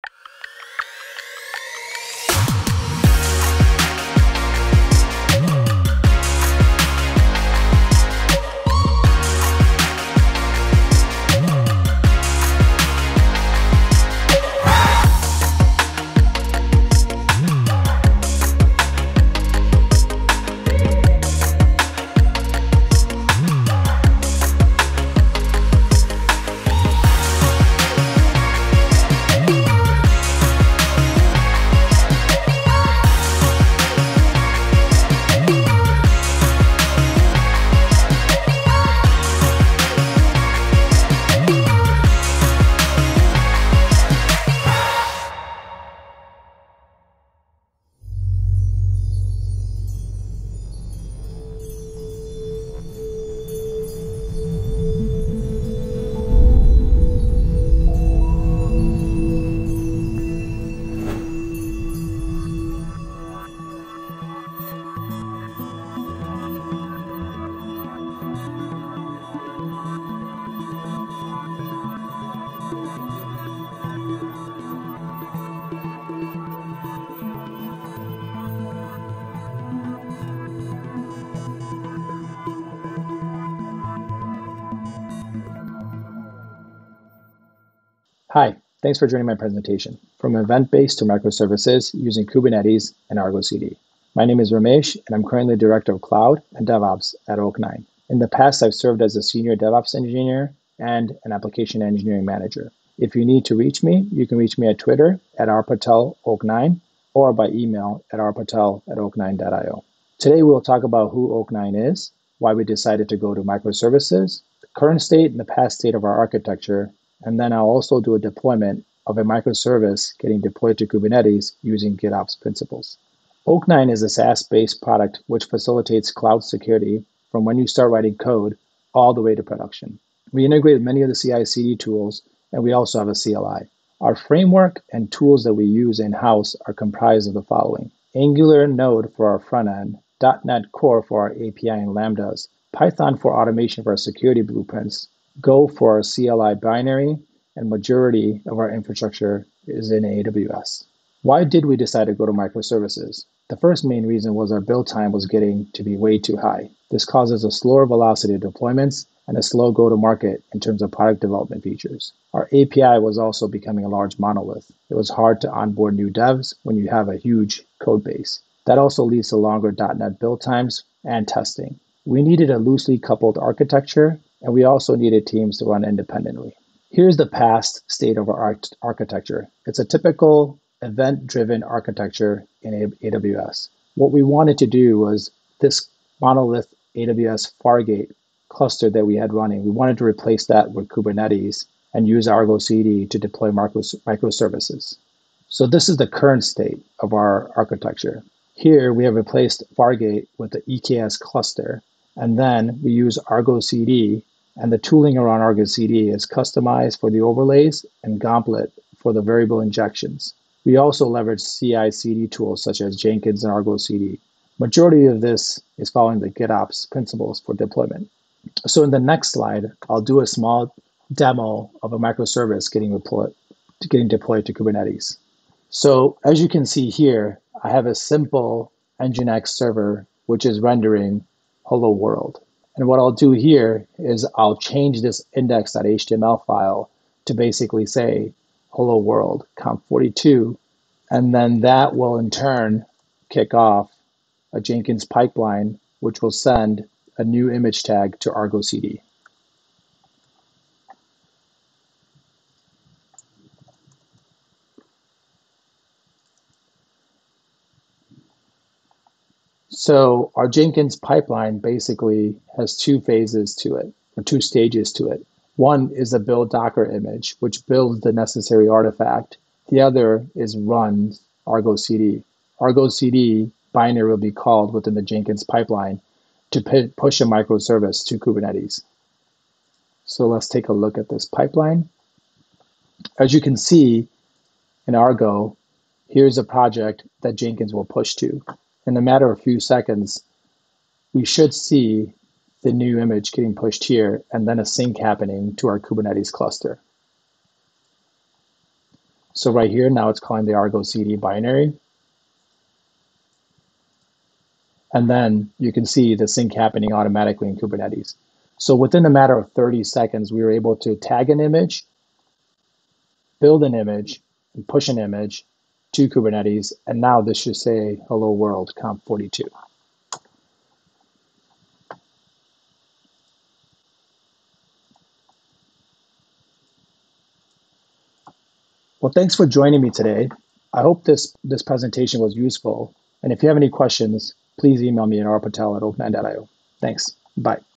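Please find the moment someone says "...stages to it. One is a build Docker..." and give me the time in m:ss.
4:24.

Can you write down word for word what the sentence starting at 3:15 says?
So, this is the current state of our architecture.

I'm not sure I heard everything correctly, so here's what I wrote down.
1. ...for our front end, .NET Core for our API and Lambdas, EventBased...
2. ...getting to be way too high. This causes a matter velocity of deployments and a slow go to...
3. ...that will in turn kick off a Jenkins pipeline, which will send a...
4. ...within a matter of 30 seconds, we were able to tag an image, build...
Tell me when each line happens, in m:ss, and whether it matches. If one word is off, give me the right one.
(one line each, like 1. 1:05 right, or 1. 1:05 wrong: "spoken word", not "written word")
1. 2:19 wrong: "Python", not "EventBased"
2. 2:35 wrong: "slower", not "matter"
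3. 4:01 right
4. 5:08 right.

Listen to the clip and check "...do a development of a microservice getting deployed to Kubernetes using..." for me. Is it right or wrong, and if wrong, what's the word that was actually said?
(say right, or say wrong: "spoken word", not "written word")
wrong: "deployment", not "development".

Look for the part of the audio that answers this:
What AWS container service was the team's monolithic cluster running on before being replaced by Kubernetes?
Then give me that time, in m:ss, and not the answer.
3:06.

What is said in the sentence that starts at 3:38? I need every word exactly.
So in the next slide, I'll do a small demo of a microservice getting deployed, getting deployed to Kubernetes.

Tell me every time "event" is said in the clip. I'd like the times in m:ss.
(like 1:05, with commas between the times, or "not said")
1:30, 3:00.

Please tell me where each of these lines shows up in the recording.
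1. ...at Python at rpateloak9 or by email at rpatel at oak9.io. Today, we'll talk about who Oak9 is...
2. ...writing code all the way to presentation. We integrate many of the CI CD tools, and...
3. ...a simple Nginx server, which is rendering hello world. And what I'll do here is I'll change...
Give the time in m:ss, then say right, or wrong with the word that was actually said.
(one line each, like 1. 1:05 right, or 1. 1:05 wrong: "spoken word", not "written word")
1. 1:44 wrong: "Twitter", not "Python"
2. 2:07 wrong: "production", not "presentation"
3. 3:47 right.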